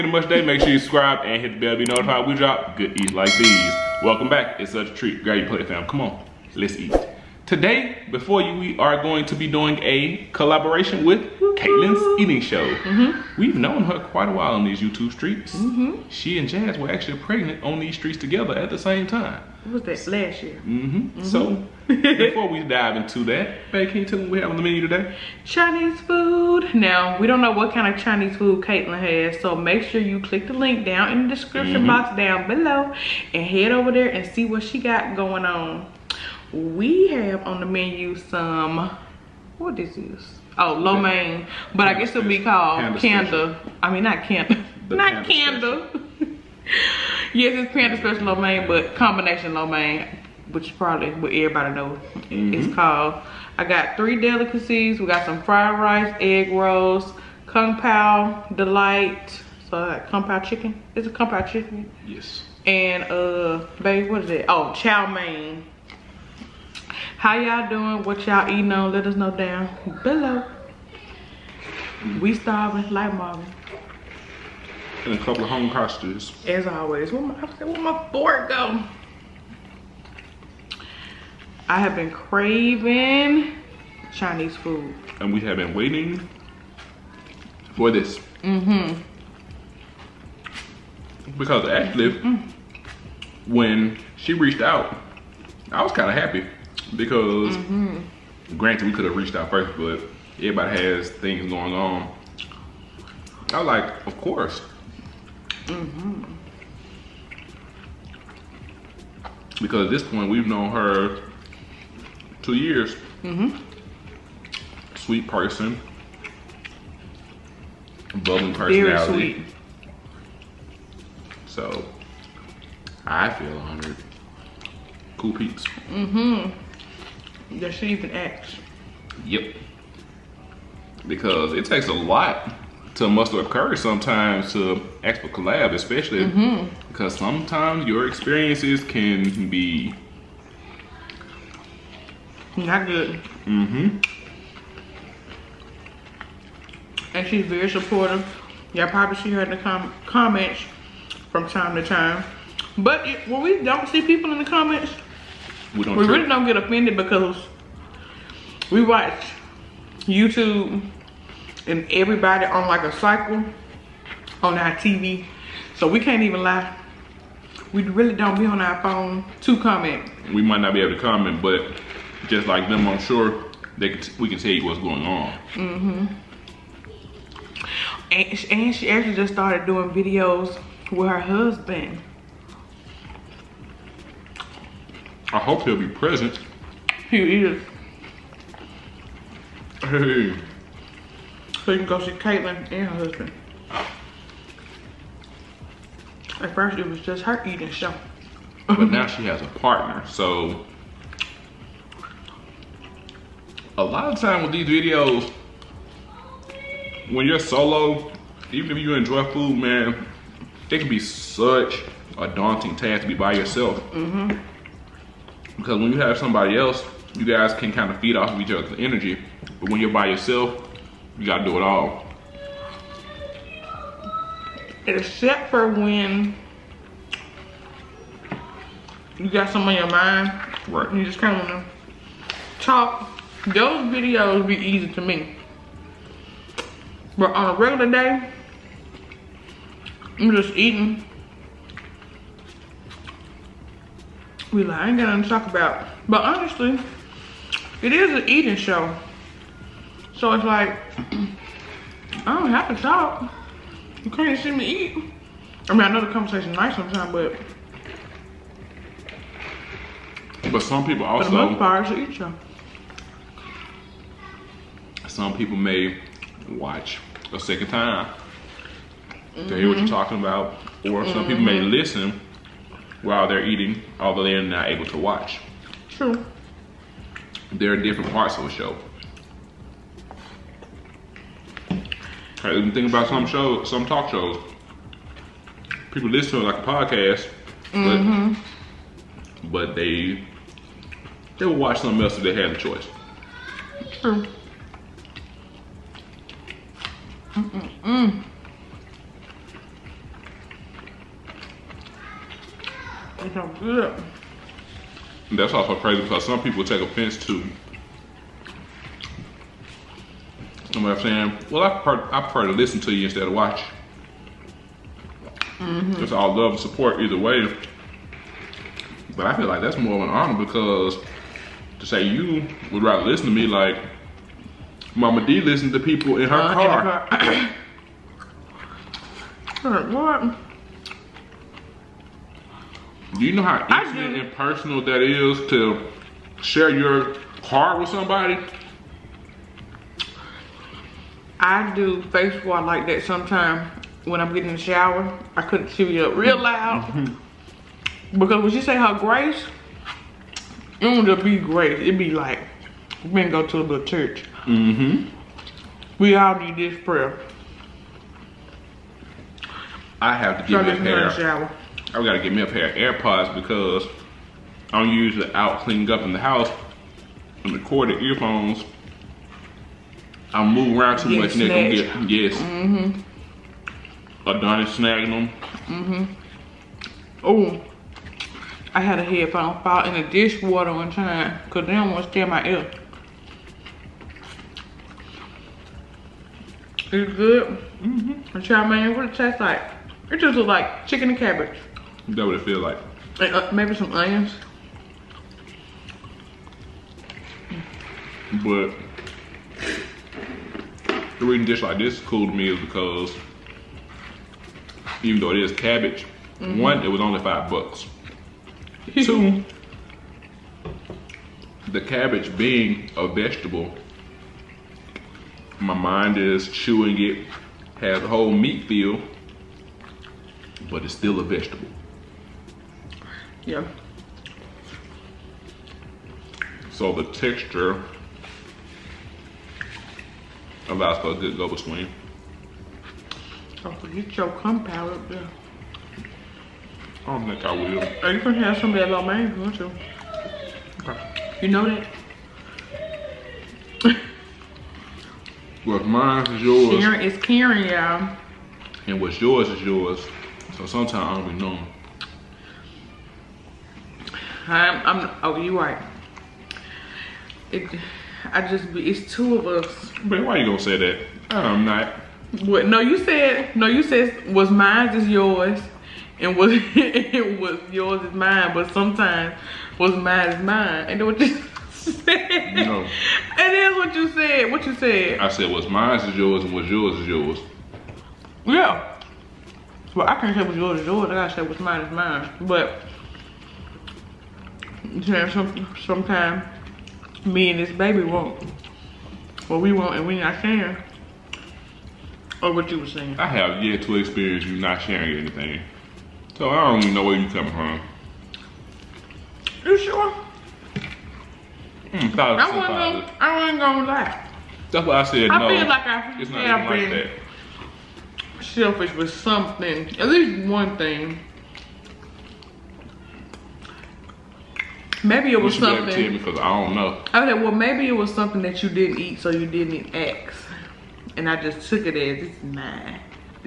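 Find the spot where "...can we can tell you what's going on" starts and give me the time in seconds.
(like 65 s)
173 s.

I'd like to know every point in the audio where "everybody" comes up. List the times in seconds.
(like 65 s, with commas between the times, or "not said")
51 s, 100 s, 161 s.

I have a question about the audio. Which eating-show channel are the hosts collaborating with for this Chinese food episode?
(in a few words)
Kaitlin's Eating Show.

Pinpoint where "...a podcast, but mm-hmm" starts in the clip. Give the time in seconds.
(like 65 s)
286 s.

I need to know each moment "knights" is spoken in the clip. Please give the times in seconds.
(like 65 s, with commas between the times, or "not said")
not said.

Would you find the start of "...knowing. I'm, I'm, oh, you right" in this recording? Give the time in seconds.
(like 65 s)
451 s.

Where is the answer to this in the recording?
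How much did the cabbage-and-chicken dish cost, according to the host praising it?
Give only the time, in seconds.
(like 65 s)
407 s.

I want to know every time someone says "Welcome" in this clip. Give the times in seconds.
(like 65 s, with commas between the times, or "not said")
4 s.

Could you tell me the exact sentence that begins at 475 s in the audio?
I said was mine is yours, and what's yours is yours.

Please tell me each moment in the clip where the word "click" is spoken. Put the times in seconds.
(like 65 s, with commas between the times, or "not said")
30 s.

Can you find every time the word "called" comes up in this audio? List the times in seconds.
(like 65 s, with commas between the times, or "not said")
42 s, 52 s.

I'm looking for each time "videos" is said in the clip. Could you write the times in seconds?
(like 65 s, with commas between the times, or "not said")
179 s, 204 s, 233 s.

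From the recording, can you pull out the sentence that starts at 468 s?
But sometimes was mine is mine.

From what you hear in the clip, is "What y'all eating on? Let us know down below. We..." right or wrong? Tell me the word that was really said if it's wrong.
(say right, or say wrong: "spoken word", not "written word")
right.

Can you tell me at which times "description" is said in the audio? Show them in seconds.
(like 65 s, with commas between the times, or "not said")
31 s.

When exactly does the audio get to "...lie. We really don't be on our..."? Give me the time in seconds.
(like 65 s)
166 s.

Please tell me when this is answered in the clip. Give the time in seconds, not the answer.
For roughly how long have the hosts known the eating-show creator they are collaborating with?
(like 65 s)
112 s.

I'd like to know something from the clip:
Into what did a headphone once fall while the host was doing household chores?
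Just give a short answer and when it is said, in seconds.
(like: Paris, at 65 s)
The dishwater, at 380 s.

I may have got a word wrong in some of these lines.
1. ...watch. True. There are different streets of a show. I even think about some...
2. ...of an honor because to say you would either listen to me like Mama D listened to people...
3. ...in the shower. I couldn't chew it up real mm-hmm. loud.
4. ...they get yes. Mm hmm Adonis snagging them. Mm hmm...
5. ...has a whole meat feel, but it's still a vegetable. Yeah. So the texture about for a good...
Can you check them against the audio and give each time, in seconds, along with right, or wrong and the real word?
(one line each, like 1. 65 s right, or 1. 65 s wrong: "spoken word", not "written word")
1. 275 s wrong: "parts", not "streets"
2. 319 s wrong: "rather", not "either"
3. 344 s right
4. 371 s right
5. 417 s right.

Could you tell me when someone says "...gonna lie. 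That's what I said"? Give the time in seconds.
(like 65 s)
503 s.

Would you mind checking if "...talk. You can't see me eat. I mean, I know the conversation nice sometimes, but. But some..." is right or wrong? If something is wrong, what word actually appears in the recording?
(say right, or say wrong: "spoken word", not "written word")
right.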